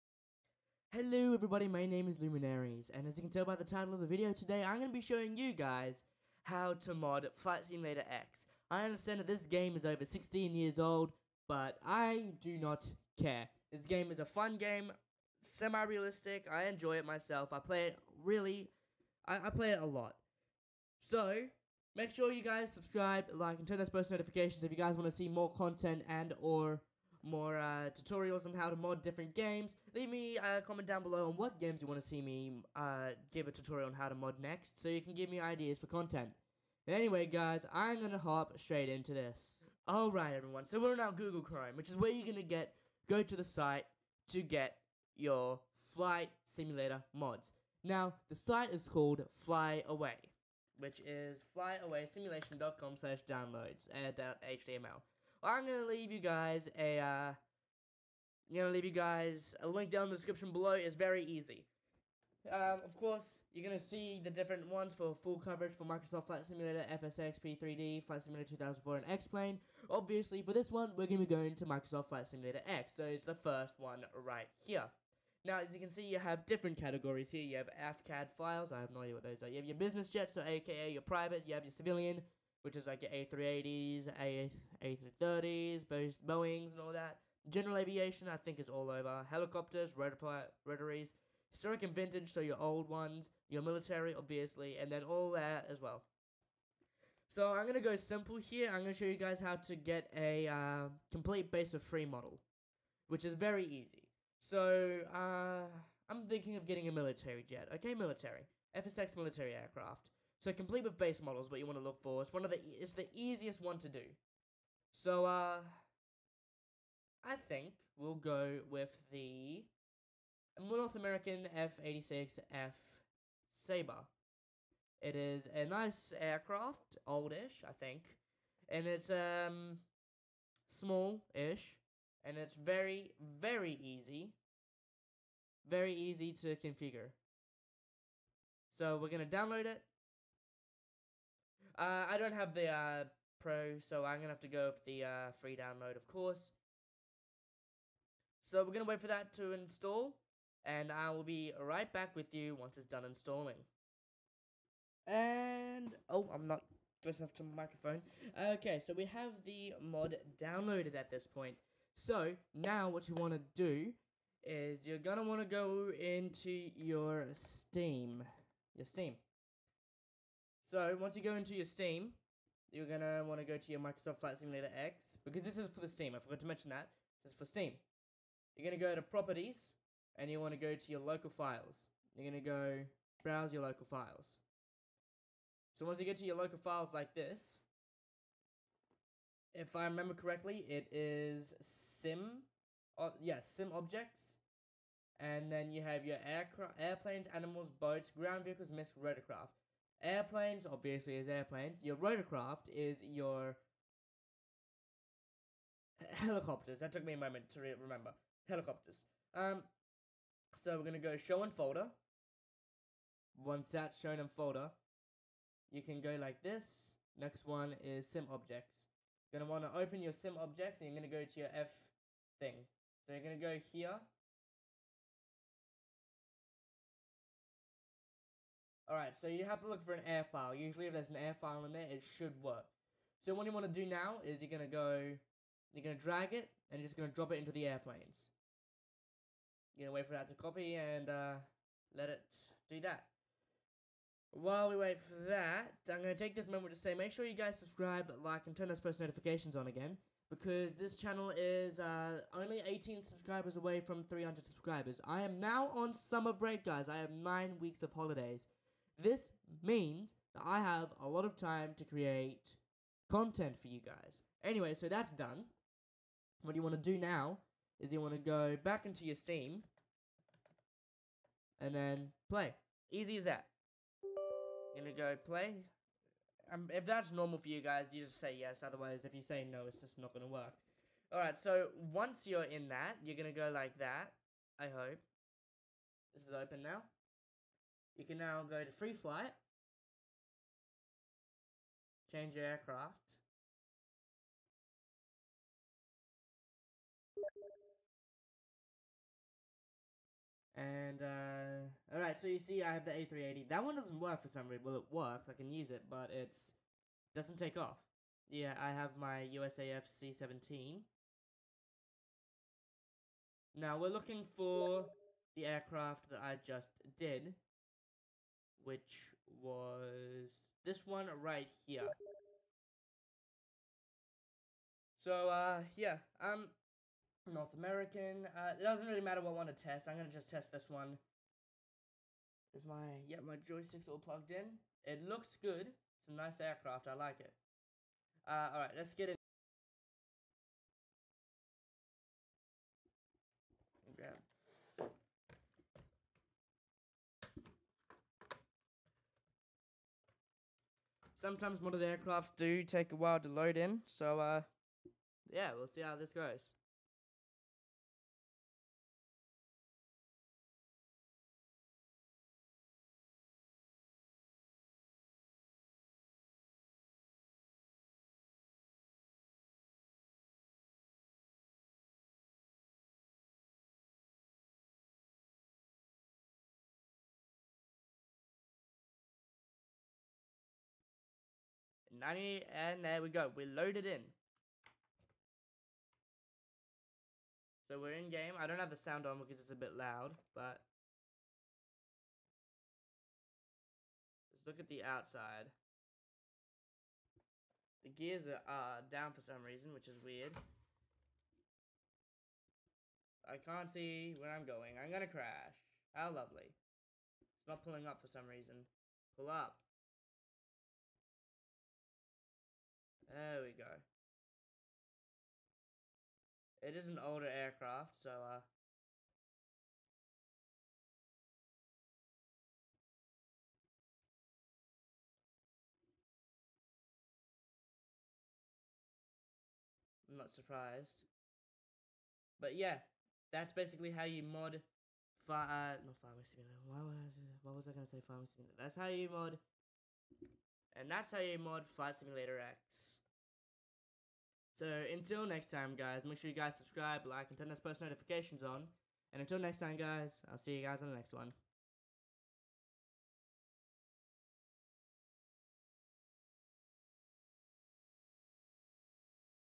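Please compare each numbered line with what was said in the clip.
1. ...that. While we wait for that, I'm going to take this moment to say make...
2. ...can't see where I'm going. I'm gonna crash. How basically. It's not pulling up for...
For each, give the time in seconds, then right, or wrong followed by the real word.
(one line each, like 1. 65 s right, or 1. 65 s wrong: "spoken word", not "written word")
1. 242 s right
2. 403 s wrong: "lovely", not "basically".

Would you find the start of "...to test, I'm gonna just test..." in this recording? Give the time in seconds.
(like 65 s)
329 s.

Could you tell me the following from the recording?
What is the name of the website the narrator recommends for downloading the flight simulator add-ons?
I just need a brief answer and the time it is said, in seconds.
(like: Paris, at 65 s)
Fly Away, at 49 s.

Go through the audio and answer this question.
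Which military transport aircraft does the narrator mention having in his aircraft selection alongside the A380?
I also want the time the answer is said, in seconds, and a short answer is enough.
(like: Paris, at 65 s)
USAF C-17, at 309 s.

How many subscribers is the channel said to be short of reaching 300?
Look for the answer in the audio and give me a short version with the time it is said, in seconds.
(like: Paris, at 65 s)
18, at 252 s.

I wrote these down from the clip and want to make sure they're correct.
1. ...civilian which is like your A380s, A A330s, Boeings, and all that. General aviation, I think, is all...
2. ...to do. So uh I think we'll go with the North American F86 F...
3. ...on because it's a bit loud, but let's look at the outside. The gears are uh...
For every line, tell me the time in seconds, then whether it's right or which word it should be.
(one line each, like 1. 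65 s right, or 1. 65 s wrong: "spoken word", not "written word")
1. 81 s right
2. 113 s right
3. 389 s right.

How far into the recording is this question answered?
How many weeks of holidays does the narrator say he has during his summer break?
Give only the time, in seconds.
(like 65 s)
257 s.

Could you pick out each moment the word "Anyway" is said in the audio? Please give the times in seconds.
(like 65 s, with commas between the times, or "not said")
36 s, 264 s.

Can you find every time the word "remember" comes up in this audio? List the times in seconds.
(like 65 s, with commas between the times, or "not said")
189 s, 207 s.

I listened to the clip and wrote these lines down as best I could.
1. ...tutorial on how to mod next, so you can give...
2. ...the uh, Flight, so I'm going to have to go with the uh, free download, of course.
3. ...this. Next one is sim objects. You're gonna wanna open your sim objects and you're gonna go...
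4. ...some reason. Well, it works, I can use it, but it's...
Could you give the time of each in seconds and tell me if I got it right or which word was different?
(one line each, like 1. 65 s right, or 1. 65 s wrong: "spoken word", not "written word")
1. 33 s right
2. 142 s wrong: "Pro", not "Flight"
3. 216 s right
4. 304 s right.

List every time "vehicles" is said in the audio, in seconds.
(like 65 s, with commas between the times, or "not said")
198 s.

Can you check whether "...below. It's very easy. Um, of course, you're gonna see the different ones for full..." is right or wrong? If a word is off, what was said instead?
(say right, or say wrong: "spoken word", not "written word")
right.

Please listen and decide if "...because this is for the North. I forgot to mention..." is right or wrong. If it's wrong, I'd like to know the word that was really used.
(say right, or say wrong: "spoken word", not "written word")
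wrong: "Steam", not "North".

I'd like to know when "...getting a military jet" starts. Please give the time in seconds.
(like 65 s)
106 s.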